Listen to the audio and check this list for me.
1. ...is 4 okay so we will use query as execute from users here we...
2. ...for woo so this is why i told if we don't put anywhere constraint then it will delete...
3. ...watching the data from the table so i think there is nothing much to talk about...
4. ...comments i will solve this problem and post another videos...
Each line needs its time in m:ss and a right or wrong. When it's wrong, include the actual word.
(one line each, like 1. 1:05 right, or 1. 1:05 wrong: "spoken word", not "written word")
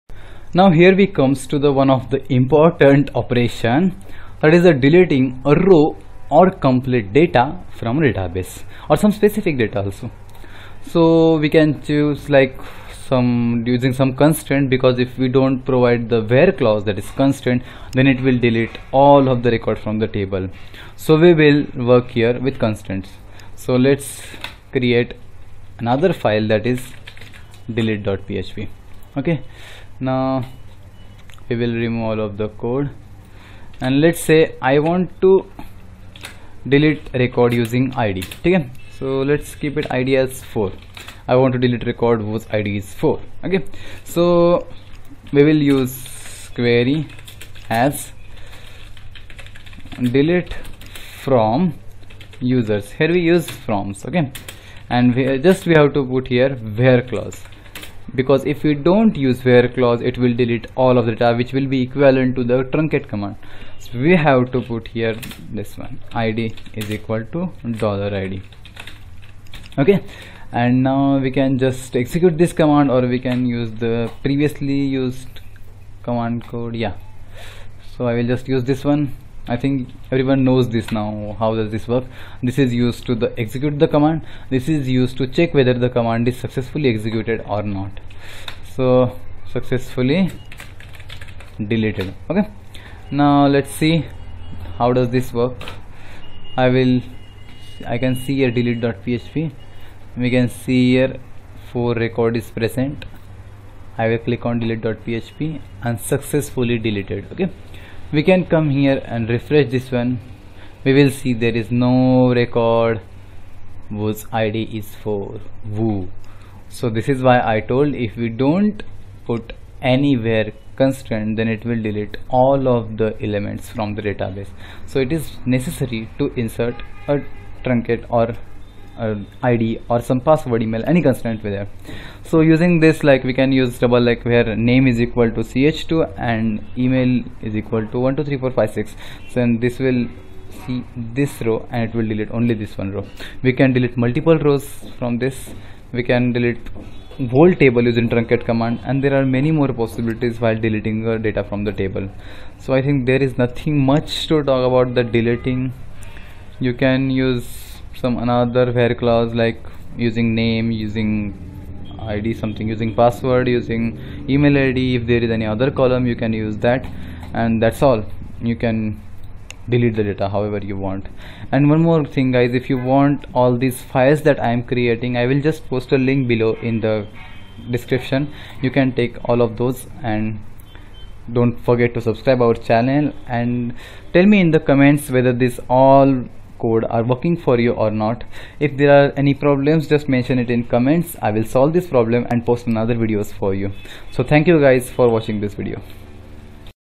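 1. 0:42 wrong: "delete", not "execute"
2. 1:55 right
3. 2:30 wrong: "deleting", not "watching"
4. 3:10 right.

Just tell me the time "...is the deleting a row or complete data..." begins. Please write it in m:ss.
0:04.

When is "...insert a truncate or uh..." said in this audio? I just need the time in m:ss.
2:06.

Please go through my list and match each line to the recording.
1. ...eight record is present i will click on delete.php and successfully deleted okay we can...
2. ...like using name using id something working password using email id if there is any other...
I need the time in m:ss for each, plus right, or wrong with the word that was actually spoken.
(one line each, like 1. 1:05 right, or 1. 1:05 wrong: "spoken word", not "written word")
1. 1:41 wrong: "four", not "eight"
2. 2:39 wrong: "using", not "working".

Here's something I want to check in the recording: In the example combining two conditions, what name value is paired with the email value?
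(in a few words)
ch2.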